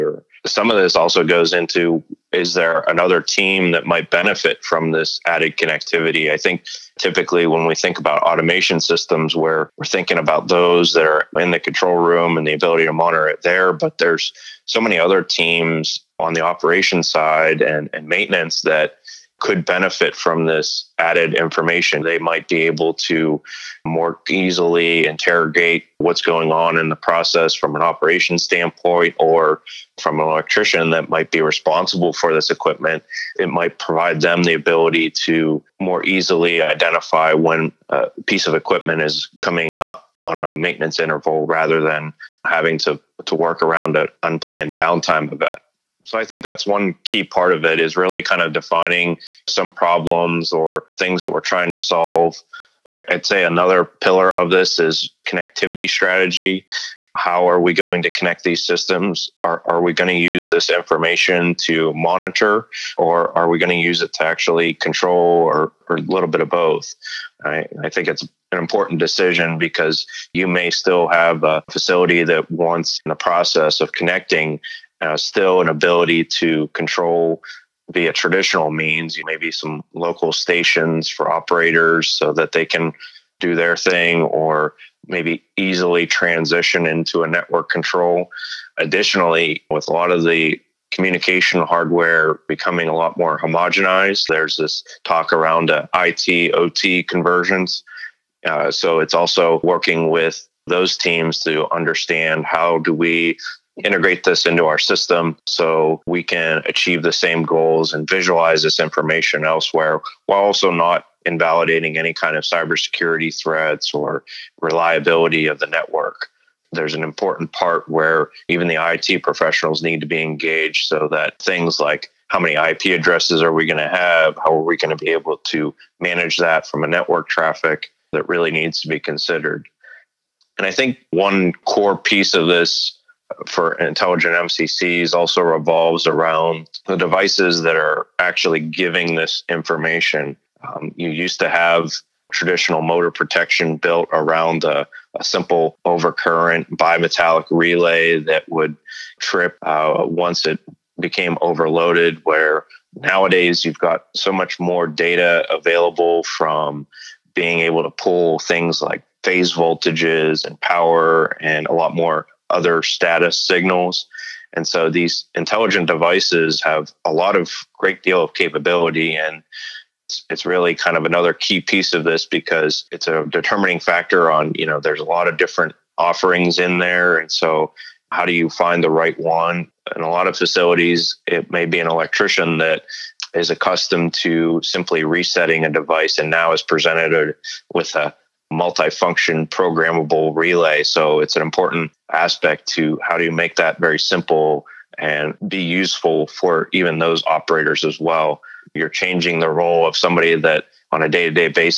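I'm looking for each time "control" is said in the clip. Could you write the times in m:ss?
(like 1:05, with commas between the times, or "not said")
0:11, 1:04, 1:16, 1:27.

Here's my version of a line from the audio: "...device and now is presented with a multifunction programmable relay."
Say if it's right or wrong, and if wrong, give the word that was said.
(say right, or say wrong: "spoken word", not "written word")
right.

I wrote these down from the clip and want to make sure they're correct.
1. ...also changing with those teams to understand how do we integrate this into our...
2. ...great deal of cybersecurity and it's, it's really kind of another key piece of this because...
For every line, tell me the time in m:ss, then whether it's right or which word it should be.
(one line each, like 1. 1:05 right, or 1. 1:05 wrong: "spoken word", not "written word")
1. 1:39 wrong: "working", not "changing"
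2. 2:47 wrong: "capability", not "cybersecurity".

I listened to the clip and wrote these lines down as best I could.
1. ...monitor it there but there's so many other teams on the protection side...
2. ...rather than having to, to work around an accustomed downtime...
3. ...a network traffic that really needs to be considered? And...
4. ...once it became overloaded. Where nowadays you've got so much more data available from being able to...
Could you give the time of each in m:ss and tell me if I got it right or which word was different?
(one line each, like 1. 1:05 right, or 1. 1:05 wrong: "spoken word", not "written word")
1. 0:12 wrong: "operation", not "protection"
2. 0:41 wrong: "unplanned", not "accustomed"
3. 2:06 right
4. 2:30 right.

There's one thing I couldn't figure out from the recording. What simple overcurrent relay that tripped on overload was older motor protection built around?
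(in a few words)
bimetallic relay.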